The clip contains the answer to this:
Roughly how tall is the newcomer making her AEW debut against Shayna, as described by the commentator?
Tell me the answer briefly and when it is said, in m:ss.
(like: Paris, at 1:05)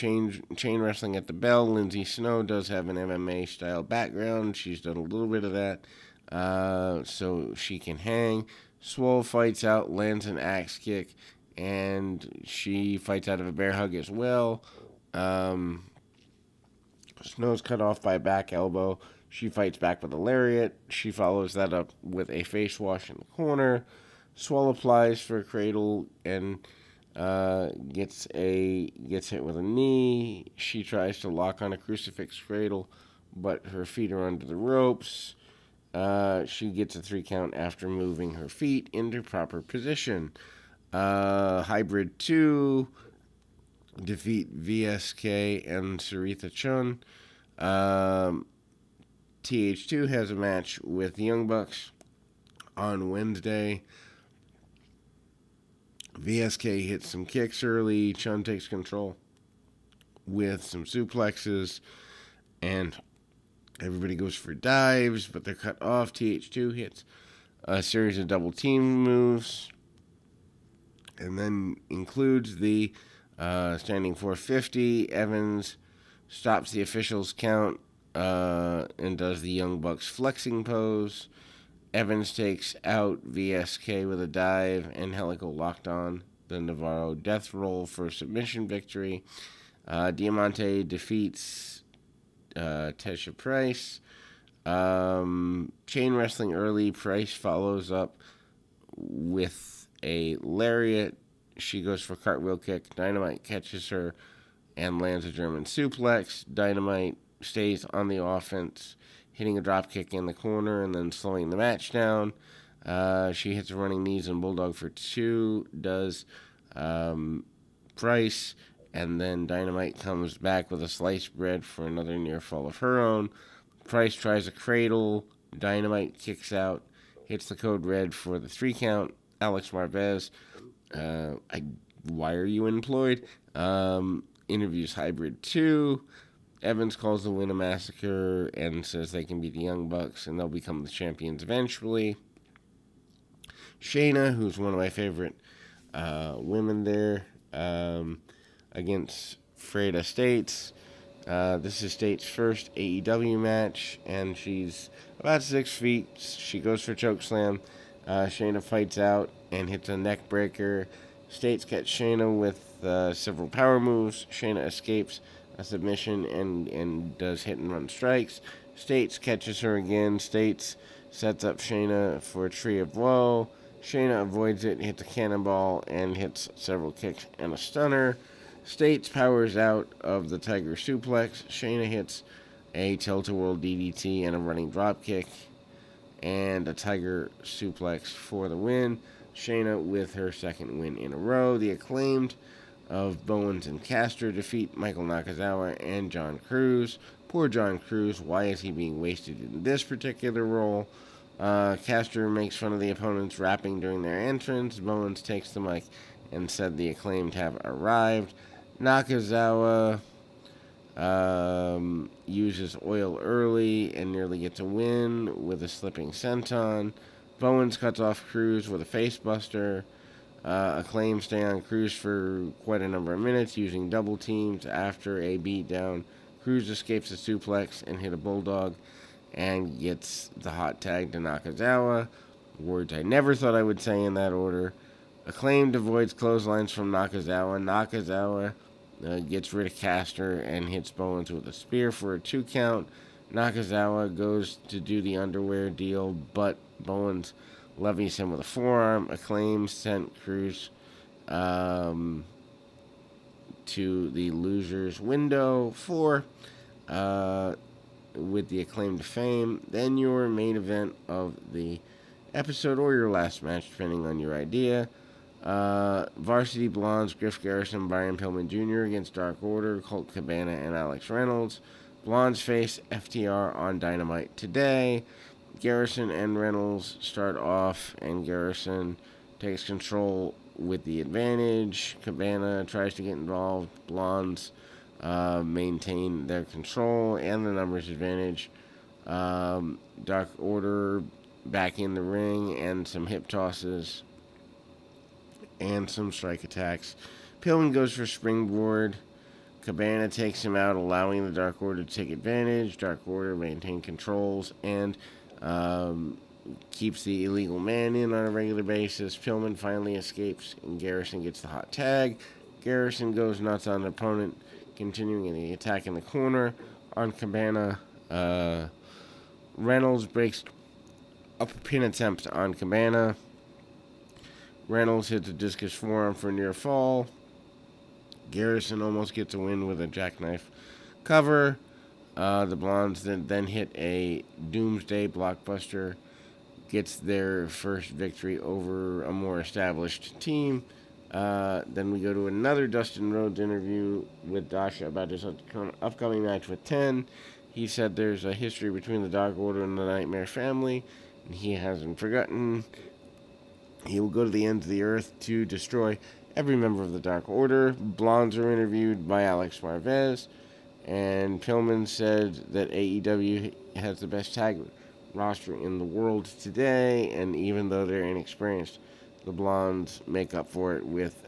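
about six feet, at 2:35.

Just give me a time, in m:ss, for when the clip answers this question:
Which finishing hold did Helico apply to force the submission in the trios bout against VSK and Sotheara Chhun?
1:26.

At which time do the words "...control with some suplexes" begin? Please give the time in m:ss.
0:58.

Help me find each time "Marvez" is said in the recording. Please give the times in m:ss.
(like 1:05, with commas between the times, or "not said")
2:09, 5:59.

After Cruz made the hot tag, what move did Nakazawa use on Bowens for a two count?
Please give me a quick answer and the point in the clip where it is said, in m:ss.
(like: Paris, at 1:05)
spear, at 4:01.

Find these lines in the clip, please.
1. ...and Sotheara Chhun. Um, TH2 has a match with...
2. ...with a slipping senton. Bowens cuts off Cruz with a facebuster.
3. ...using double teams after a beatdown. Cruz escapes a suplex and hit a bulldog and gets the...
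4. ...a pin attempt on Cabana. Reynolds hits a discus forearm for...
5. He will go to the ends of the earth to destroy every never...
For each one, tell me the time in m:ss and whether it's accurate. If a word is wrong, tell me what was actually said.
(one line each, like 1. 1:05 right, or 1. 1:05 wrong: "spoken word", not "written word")
1. 0:45 right
2. 3:35 right
3. 3:43 right
4. 5:21 right
5. 5:53 wrong: "member", not "never".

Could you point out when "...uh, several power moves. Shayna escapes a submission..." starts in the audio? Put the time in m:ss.
2:42.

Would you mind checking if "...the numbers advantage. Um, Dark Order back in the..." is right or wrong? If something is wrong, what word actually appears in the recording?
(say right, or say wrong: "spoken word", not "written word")
right.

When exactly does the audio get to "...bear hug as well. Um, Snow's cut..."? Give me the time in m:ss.
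0:13.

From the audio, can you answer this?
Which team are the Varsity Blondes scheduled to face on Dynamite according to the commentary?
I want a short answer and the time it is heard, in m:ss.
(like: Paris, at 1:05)
FTR, at 4:32.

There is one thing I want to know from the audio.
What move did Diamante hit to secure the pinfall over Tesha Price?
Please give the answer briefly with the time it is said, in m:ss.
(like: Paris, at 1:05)
Code Red, at 2:07.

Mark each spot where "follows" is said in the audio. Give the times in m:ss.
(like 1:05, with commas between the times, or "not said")
0:21, 1:37.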